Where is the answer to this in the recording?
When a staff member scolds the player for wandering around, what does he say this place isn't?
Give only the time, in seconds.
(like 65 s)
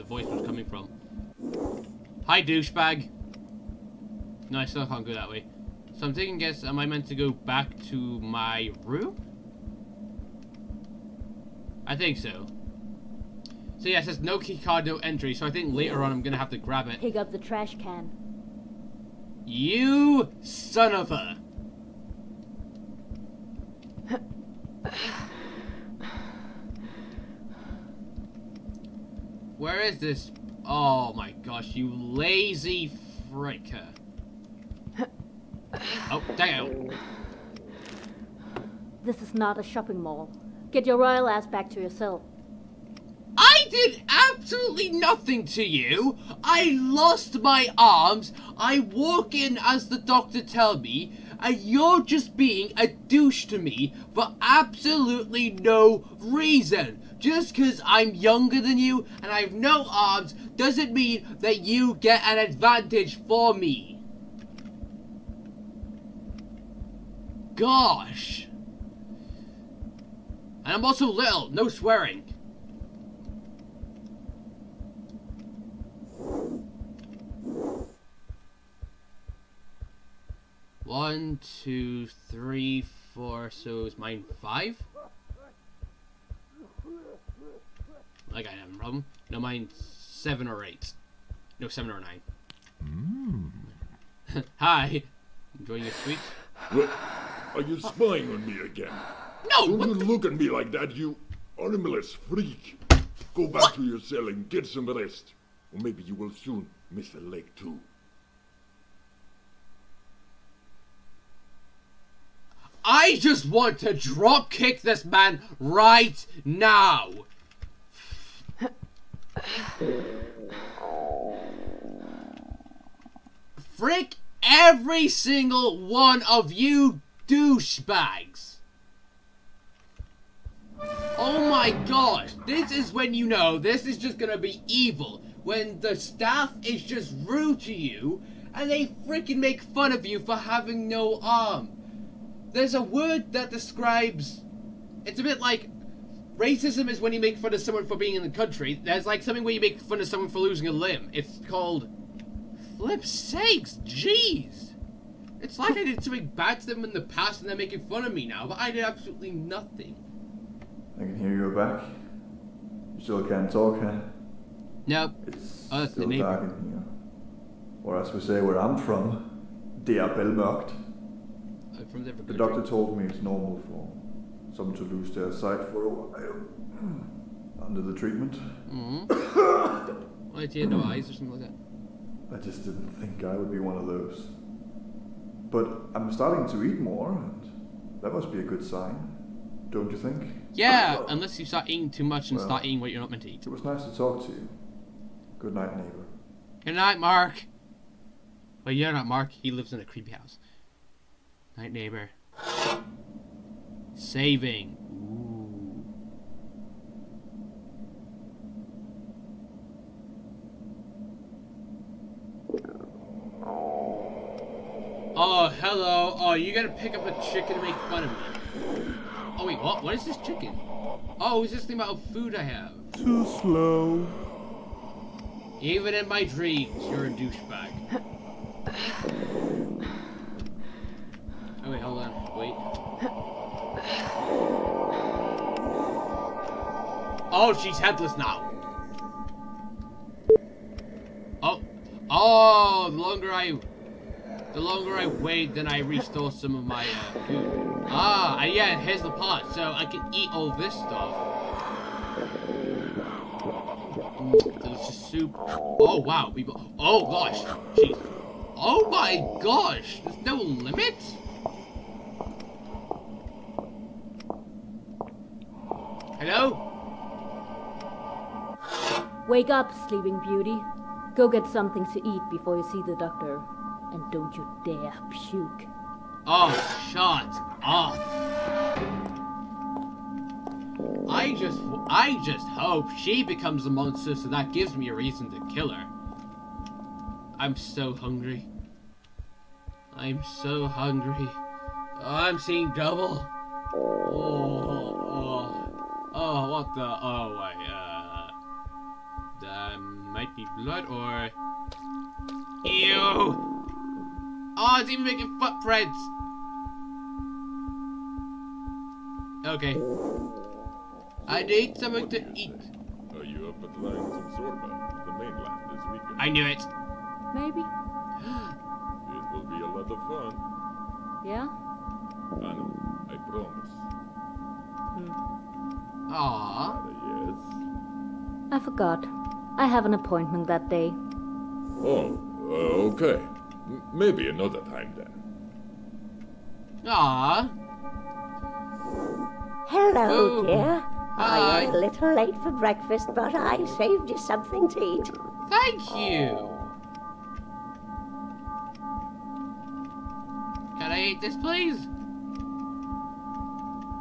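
39 s.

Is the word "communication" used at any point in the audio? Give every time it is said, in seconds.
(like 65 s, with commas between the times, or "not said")
not said.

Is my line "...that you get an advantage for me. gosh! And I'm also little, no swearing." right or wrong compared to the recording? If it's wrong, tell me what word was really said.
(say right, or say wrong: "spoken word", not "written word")
right.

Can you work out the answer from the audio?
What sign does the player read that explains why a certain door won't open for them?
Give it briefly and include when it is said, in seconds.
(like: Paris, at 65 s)
No key card, no entry, at 14 s.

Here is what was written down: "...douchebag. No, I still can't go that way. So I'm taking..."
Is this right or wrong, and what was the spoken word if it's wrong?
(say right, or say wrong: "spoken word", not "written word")
right.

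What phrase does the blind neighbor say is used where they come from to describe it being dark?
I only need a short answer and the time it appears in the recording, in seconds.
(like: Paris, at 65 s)
Der Bellmørkt, at 169 s.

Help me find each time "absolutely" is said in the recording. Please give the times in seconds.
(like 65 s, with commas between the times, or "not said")
44 s, 54 s, 158 s.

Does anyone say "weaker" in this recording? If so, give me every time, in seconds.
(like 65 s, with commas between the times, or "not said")
315 s.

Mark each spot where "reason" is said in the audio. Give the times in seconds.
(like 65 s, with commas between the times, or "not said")
56 s, 284 s.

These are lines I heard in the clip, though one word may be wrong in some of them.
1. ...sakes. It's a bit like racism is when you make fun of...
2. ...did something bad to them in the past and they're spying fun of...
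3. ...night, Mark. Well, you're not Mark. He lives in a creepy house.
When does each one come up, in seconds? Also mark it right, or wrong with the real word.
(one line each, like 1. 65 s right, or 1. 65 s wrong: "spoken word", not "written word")
1. 143 s wrong: "describes", not "sakes"
2. 155 s wrong: "making", not "spying"
3. 196 s right.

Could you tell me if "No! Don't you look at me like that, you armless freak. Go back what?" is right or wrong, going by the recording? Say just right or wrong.
right.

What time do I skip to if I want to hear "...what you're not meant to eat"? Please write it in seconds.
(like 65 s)
192 s.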